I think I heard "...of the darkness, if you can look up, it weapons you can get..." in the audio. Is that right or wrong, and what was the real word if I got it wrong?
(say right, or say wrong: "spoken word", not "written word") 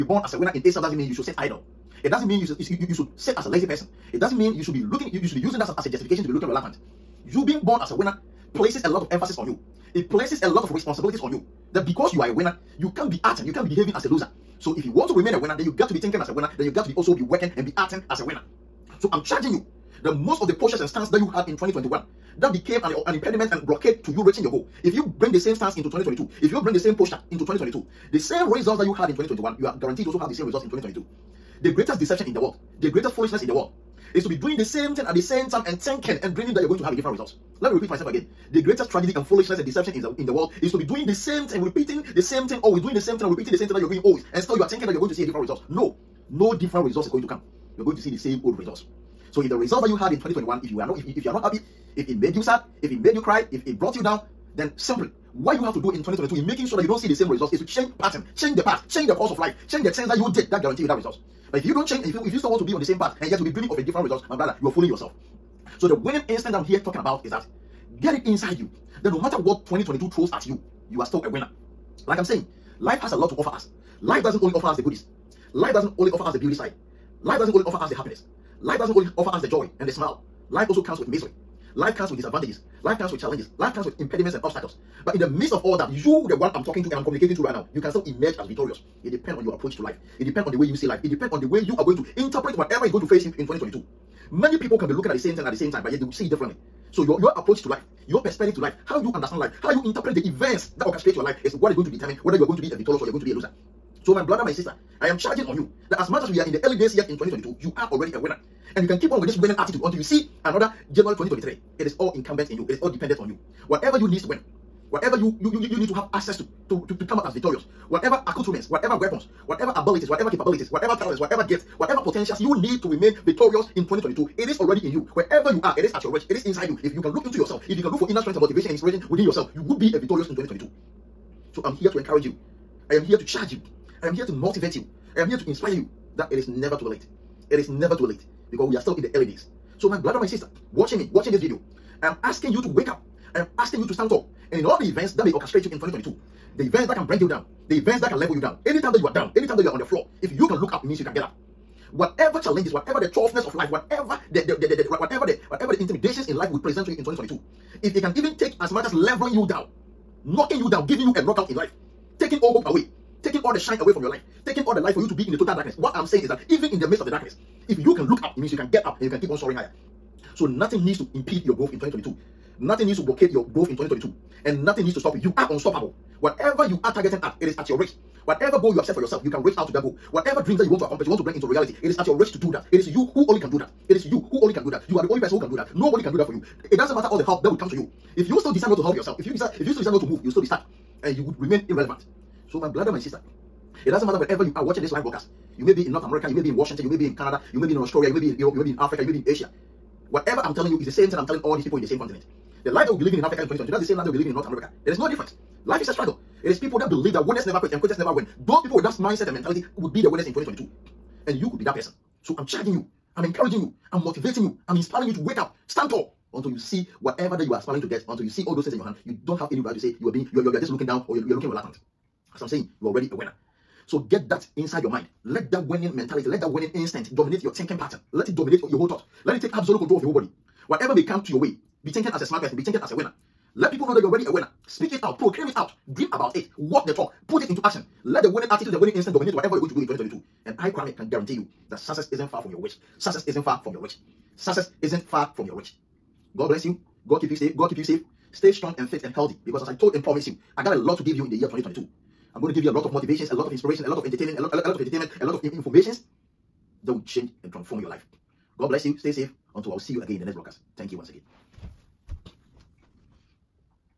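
wrong: "means", not "weapons".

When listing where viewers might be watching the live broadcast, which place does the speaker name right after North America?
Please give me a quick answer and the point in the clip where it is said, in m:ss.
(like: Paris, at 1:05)
Washington, at 3:16.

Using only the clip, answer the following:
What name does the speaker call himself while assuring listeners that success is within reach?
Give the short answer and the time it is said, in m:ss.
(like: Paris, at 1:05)
Kwame, at 4:00.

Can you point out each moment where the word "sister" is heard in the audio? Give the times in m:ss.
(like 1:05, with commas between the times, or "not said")
1:44, 2:20, 3:12.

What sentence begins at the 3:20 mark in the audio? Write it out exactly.
Whatever I'm telling you is the same thing I'm telling all these people in the same continent.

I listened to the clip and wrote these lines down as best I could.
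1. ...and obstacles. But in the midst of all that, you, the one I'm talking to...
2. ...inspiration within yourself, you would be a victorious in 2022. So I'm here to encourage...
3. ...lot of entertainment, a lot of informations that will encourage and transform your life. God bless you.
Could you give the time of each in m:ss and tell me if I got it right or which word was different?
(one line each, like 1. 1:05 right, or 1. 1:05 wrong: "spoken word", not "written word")
1. 1:24 right
2. 2:08 right
3. 4:14 wrong: "change", not "encourage".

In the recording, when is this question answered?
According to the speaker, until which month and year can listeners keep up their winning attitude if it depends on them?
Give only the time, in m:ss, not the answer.
1:50.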